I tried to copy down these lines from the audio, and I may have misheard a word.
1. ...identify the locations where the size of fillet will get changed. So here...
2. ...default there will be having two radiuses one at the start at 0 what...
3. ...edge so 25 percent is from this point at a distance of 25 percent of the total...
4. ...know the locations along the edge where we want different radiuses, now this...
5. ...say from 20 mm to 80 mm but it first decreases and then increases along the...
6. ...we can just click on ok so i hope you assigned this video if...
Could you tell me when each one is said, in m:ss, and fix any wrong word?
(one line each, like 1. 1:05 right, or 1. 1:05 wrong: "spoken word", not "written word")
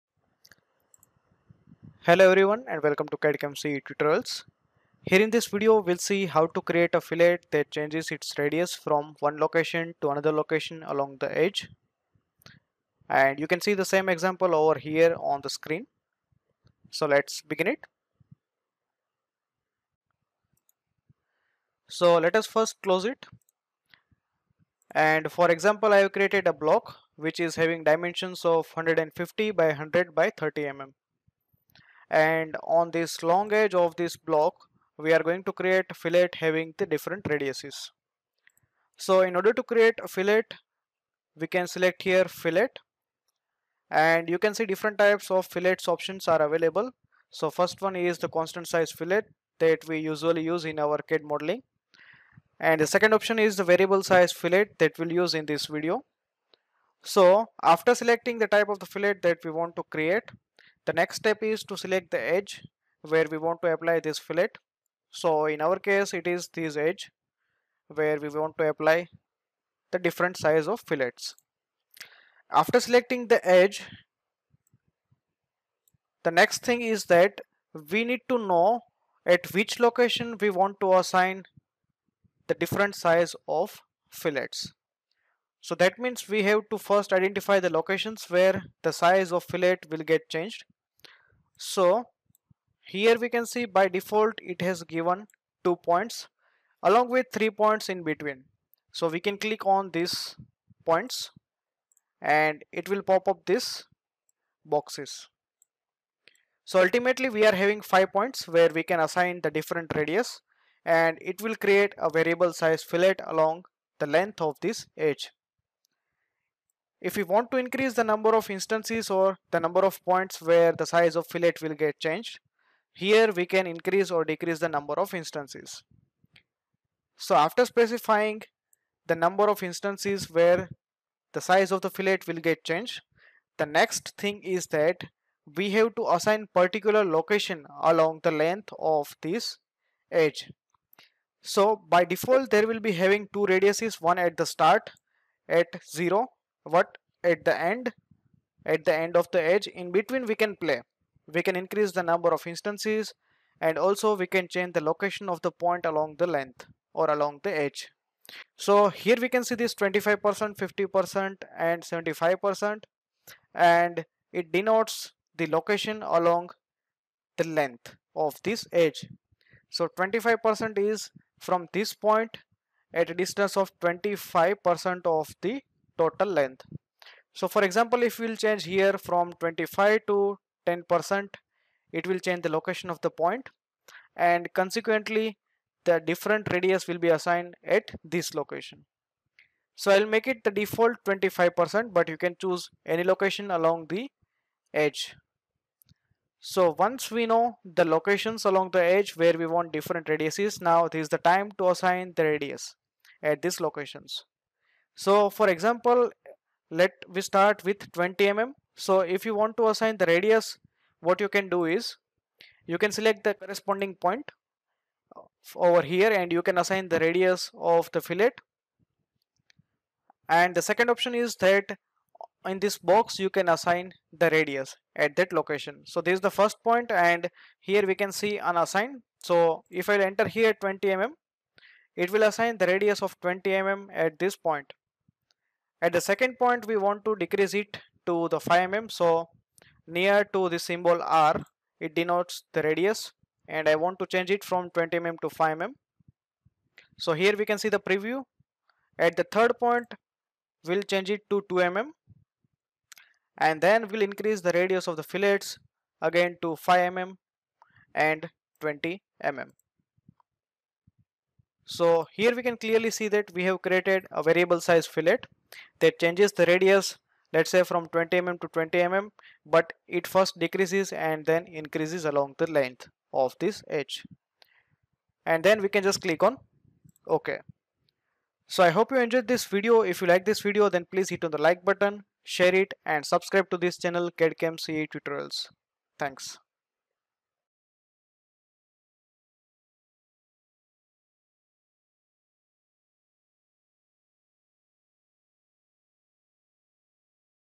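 1. 1:27 right
2. 2:22 right
3. 2:48 right
4. 3:17 right
5. 4:27 wrong: "20", not "80"
6. 4:35 wrong: "enjoyed", not "assigned".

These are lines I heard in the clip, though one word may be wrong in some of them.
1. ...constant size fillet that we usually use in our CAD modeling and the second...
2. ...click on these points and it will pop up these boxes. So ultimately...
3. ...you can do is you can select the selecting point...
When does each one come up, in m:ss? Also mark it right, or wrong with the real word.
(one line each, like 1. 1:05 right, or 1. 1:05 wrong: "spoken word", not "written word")
1. 0:48 right
2. 1:39 right
3. 3:31 wrong: "corresponding", not "selecting".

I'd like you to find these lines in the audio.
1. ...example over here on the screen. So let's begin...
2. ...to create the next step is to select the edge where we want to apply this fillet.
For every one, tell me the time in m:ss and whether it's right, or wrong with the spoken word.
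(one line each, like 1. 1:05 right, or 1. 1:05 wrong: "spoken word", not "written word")
1. 0:14 right
2. 0:59 right.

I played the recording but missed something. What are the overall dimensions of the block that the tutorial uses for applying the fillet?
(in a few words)
150 by 100 by 30 mm.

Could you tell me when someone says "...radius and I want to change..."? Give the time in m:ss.
4:02.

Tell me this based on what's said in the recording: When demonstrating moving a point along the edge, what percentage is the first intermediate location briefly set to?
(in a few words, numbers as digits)
10%.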